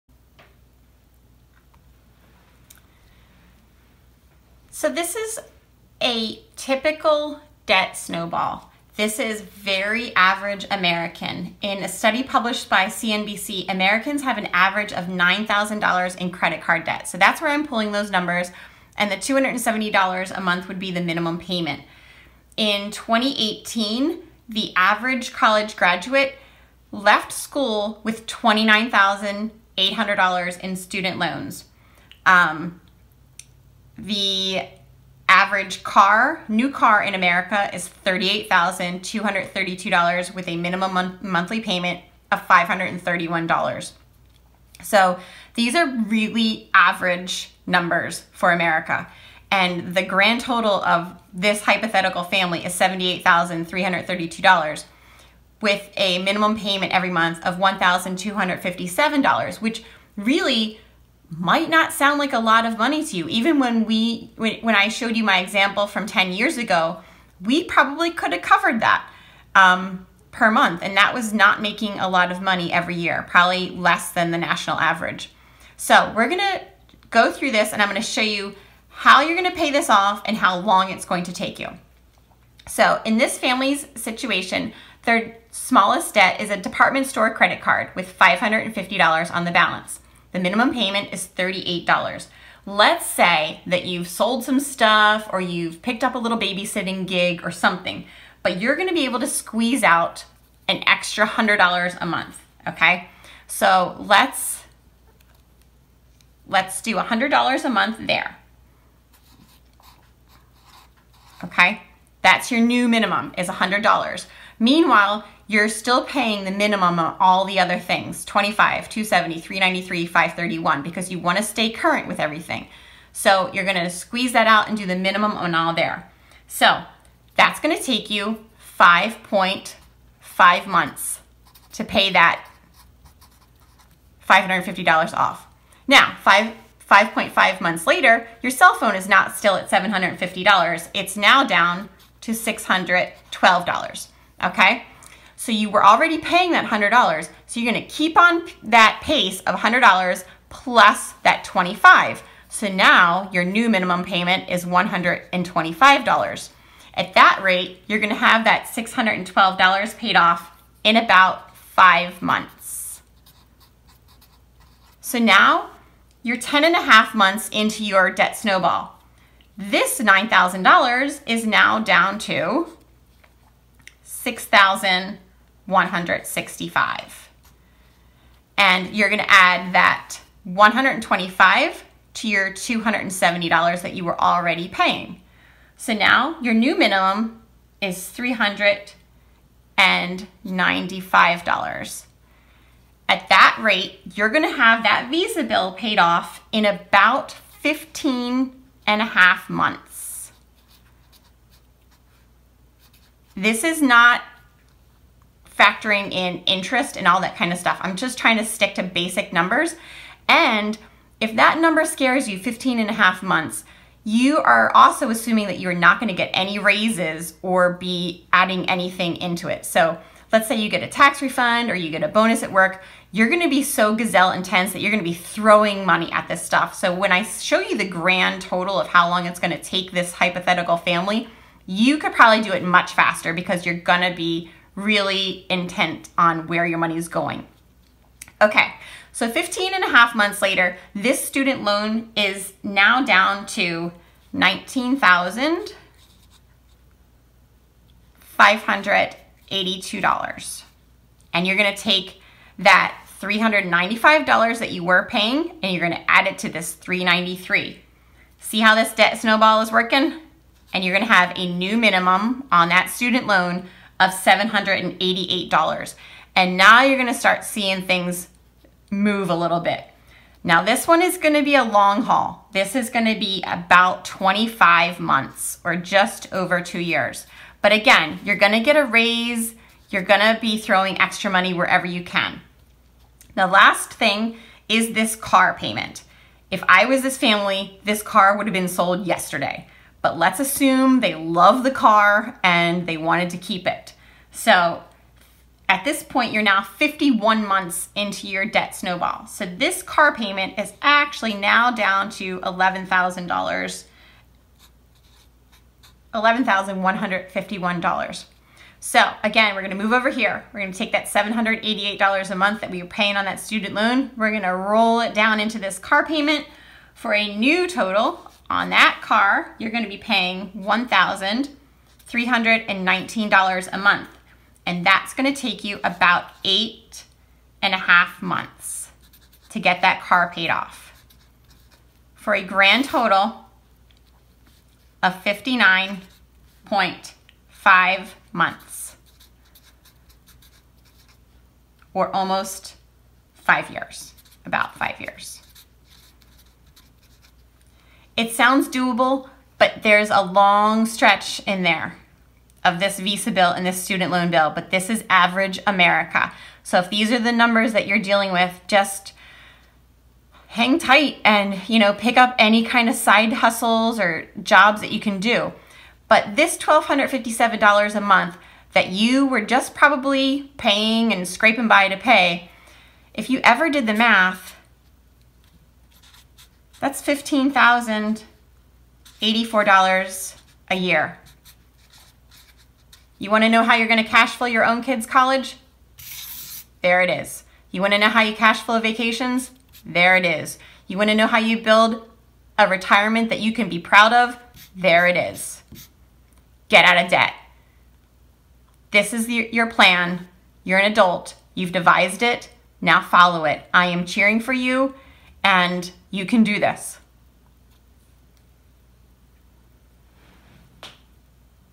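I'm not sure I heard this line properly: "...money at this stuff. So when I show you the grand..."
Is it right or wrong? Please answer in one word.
right.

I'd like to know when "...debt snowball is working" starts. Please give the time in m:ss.
4:18.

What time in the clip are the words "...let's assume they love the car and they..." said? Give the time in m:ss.
4:50.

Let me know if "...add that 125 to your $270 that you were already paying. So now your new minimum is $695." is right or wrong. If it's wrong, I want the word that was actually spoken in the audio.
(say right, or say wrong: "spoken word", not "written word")
wrong: "395", not "695".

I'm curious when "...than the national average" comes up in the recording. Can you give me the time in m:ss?
1:14.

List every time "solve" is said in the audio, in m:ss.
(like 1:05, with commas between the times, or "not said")
not said.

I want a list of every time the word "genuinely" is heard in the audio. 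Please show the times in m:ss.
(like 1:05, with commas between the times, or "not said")
not said.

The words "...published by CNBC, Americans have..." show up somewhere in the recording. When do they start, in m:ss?
0:12.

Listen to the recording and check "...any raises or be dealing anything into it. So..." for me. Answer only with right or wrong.
wrong.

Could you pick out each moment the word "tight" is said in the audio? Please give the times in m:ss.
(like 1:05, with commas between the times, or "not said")
6:00.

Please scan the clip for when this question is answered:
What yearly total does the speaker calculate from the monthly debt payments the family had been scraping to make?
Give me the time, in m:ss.
6:17.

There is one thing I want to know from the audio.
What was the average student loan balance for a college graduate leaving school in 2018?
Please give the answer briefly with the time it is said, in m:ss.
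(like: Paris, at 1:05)
$29,800, at 0:28.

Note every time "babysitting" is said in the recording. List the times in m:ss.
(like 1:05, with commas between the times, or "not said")
1:36.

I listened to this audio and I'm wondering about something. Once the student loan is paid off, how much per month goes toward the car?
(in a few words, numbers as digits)
$1,319.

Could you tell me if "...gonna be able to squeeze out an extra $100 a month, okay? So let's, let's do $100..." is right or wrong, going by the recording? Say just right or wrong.
right.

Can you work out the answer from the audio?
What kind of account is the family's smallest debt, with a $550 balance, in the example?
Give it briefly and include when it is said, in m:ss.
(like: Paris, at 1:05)
department store credit card, at 1:26.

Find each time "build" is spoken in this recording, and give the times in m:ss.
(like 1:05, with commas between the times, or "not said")
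6:31.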